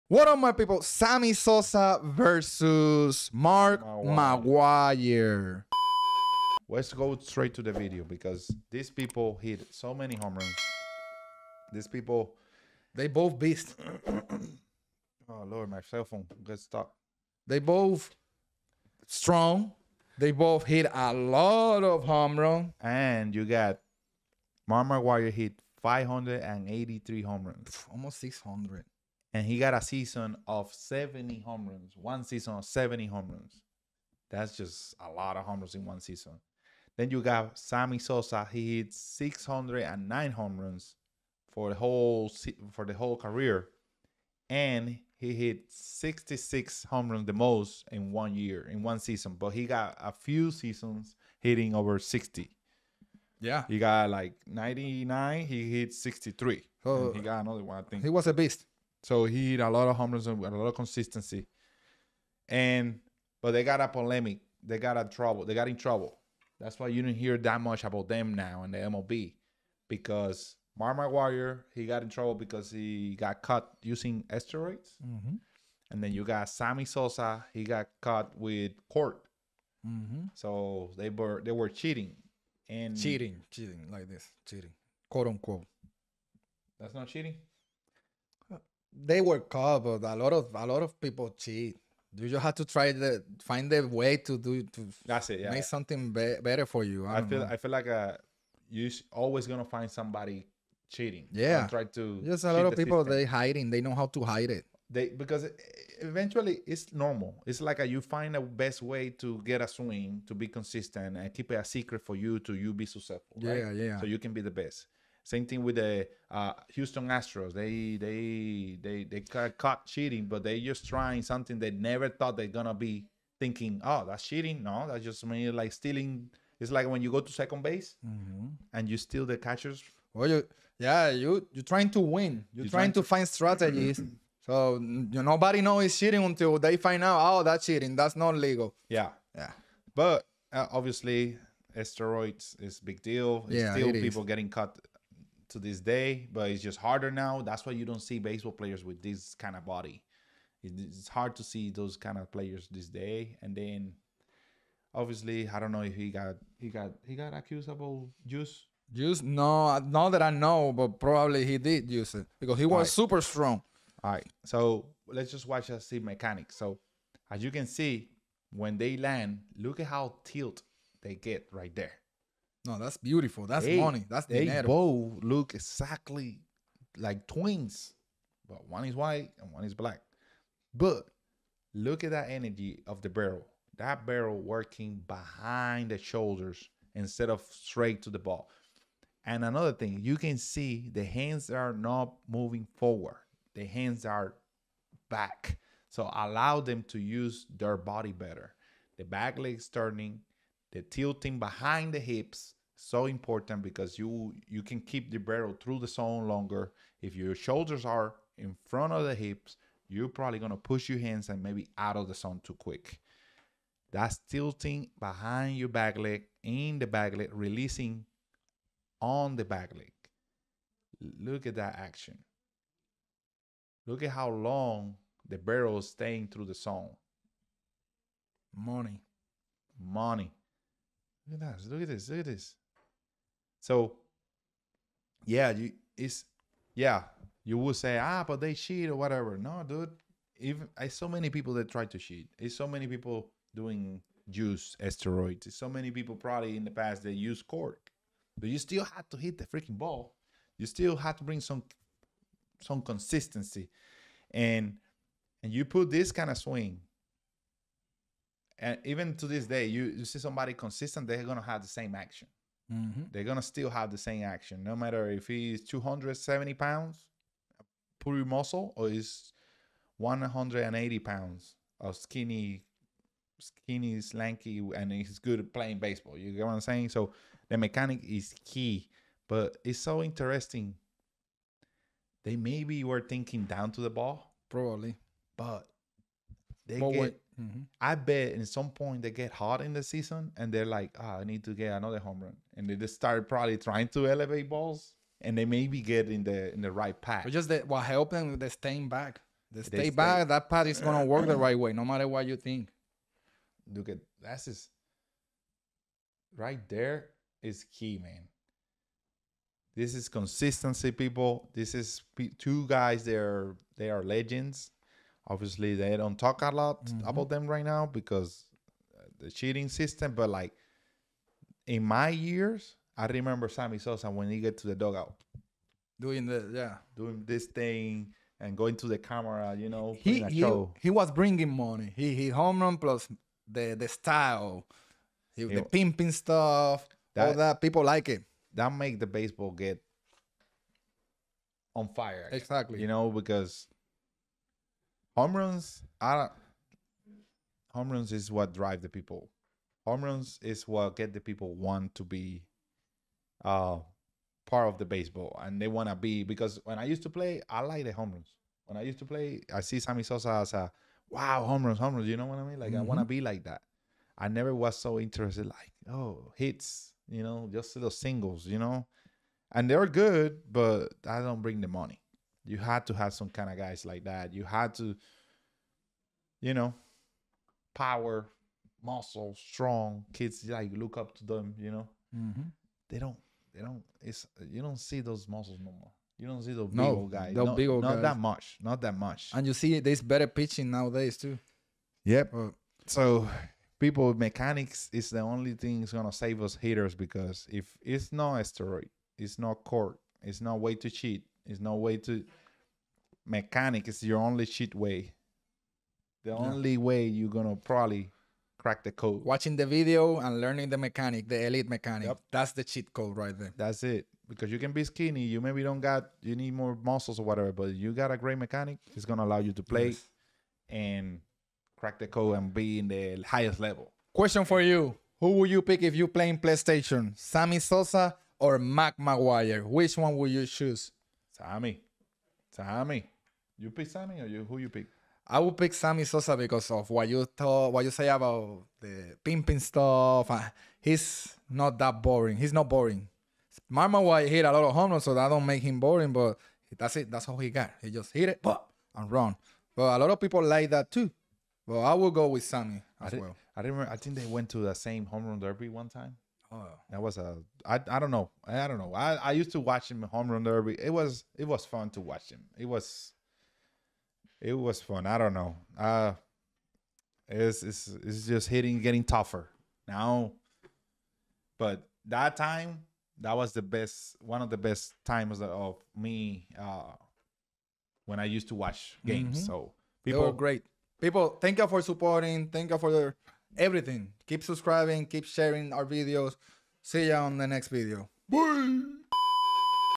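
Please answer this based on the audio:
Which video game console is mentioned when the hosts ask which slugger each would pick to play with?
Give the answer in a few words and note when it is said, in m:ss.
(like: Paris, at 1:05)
PlayStation, at 7:06.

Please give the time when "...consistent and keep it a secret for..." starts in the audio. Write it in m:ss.
1:50.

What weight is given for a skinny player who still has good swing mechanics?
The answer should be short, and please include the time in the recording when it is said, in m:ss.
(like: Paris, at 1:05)
180 pounds, at 4:29.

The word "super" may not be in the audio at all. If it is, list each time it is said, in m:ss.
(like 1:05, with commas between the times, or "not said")
2:42.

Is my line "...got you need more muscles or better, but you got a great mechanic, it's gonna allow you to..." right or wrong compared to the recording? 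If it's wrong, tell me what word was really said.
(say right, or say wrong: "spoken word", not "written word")
wrong: "whatever", not "better".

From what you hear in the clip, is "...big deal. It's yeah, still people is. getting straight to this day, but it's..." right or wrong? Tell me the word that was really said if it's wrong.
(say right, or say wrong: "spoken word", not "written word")
wrong: "caught", not "straight".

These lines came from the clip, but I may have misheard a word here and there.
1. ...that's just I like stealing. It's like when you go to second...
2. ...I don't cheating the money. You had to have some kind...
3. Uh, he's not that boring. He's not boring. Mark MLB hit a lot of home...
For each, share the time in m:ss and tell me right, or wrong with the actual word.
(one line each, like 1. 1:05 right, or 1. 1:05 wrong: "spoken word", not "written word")
1. 2:04 right
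2. 6:11 wrong: "bring", not "cheating"
3. 7:20 wrong: "McGwire", not "MLB".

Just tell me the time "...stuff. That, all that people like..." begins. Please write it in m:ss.
5:36.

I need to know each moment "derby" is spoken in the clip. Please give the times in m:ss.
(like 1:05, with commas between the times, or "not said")
7:35, 7:40.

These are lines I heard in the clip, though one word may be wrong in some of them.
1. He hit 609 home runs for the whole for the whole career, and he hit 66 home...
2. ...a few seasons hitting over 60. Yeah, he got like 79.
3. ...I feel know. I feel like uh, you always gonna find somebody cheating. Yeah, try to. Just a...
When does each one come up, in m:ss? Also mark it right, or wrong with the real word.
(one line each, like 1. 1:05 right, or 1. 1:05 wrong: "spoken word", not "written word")
1. 0:38 right
2. 0:49 wrong: "99", not "79"
3. 1:37 right.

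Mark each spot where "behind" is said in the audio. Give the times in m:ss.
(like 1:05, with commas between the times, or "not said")
3:05, 3:21, 3:34.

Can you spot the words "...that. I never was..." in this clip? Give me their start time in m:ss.
6:03.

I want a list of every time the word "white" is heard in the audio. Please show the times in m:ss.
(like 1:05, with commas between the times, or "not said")
2:58.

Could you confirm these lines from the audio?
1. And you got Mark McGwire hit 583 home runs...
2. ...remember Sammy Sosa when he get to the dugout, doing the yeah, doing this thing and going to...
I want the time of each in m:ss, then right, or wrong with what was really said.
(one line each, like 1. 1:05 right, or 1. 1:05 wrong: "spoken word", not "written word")
1. 0:22 right
2. 5:23 right.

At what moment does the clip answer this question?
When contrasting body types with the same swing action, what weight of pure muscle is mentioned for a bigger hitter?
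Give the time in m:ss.
4:25.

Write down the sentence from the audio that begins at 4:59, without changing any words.
the stay, back, that path is gonna work the right way, no matter what you think.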